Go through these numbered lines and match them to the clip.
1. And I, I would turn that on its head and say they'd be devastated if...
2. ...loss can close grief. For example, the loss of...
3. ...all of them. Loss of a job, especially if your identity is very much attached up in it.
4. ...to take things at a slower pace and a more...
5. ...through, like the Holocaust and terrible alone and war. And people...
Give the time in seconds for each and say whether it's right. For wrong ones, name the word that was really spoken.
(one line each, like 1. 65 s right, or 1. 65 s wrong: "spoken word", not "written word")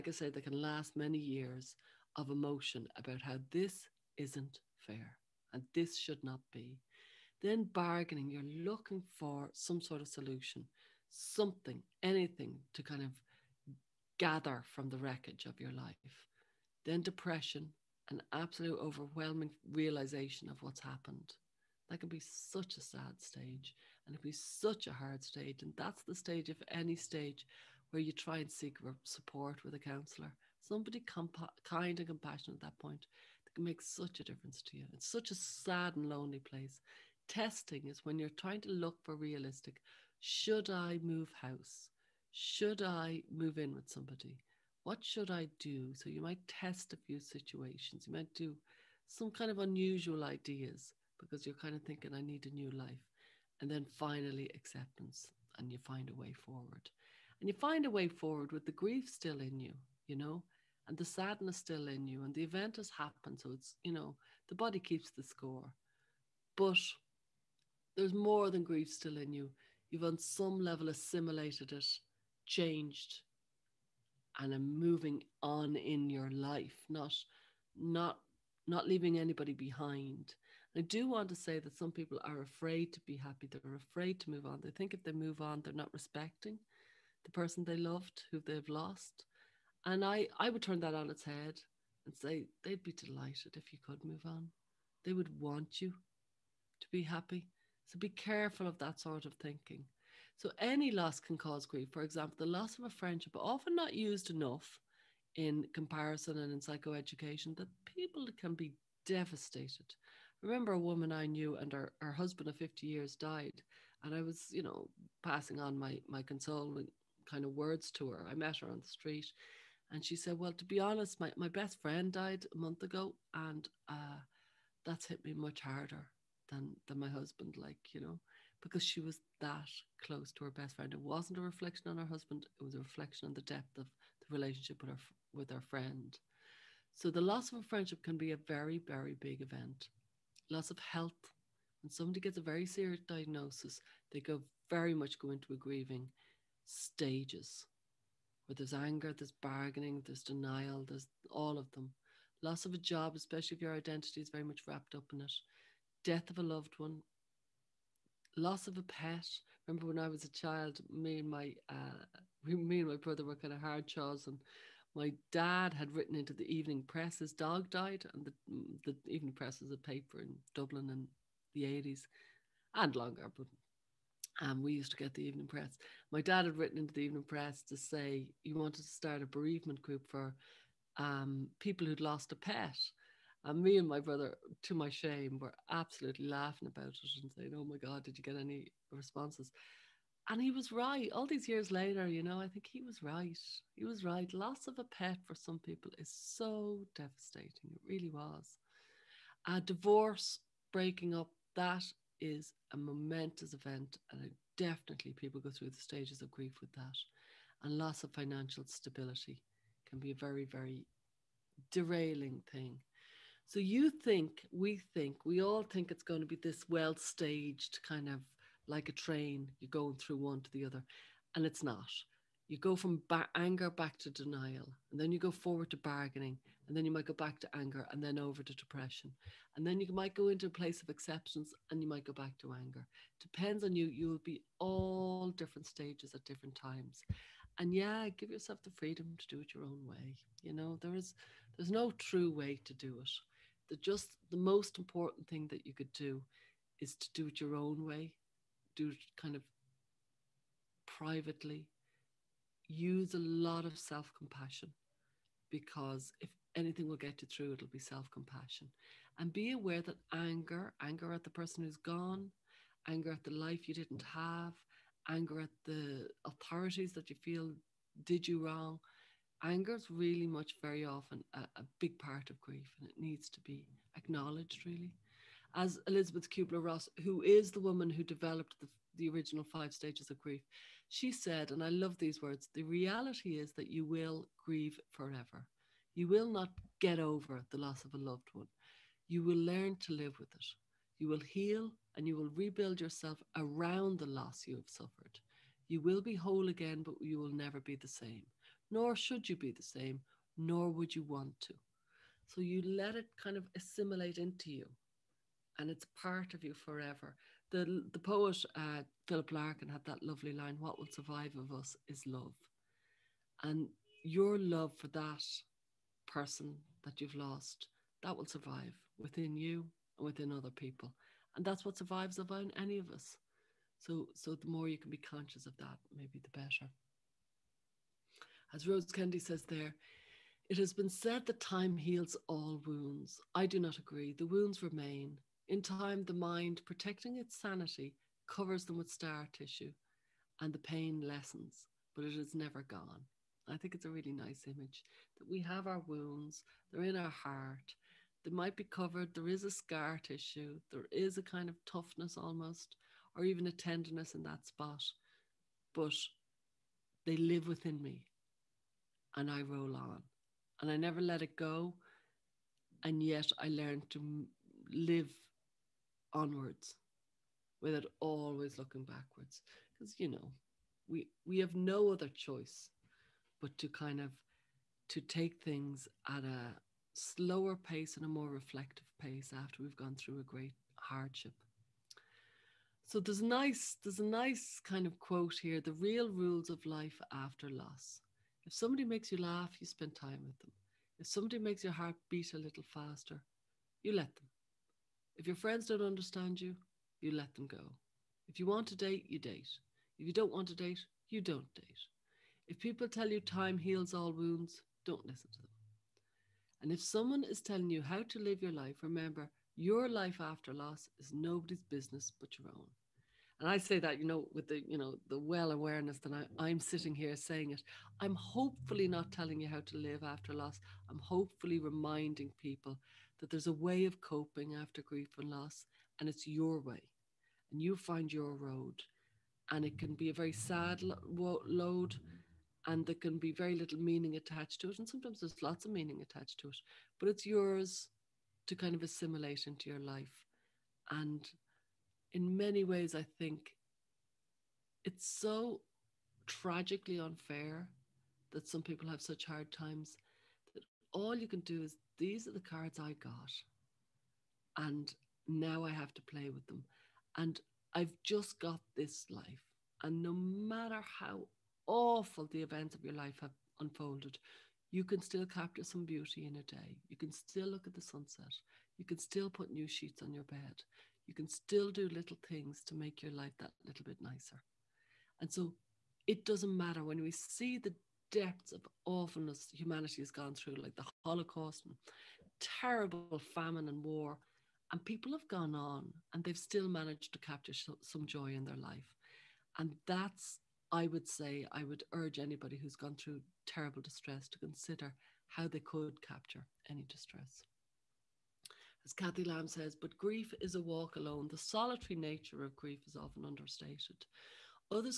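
1. 89 s wrong: "delighted", not "devastated"
2. 100 s wrong: "cause", not "close"
3. 151 s wrong: "wrapped", not "attached"
4. 374 s right
5. 480 s wrong: "famine", not "alone".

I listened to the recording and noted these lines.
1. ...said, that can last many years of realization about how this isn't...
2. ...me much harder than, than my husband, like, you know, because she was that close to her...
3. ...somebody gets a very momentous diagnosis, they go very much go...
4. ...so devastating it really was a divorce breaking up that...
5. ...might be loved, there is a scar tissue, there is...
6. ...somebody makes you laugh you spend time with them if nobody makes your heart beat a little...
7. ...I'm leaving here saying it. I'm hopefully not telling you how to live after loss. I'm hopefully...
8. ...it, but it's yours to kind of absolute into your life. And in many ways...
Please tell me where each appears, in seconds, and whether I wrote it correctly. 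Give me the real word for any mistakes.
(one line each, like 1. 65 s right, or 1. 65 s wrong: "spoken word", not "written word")
1. 0 s wrong: "emotion", not "realization"
2. 125 s right
3. 141 s wrong: "serious", not "momentous"
4. 196 s right
5. 348 s wrong: "covered", not "loved"
6. 388 s wrong: "somebody", not "nobody"
7. 416 s wrong: "sitting", not "leaving"
8. 436 s wrong: "assimilate", not "absolute".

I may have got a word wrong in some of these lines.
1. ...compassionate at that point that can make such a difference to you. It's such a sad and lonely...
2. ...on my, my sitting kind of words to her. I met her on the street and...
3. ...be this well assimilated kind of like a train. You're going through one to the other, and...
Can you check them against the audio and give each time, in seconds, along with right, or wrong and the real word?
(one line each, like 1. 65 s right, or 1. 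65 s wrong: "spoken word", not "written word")
1. 32 s right
2. 115 s wrong: "consoling", not "sitting"
3. 216 s wrong: "staged", not "assimilated".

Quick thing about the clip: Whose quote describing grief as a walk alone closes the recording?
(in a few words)
Cathy Lamb.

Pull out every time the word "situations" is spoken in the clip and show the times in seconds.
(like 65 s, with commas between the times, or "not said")
47 s.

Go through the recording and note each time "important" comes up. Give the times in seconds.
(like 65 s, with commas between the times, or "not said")
244 s.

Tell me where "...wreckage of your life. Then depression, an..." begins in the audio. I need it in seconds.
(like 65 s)
14 s.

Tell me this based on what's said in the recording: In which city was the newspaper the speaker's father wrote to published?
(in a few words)
Dublin.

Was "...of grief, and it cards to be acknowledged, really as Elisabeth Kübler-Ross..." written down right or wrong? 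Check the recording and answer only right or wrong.
wrong.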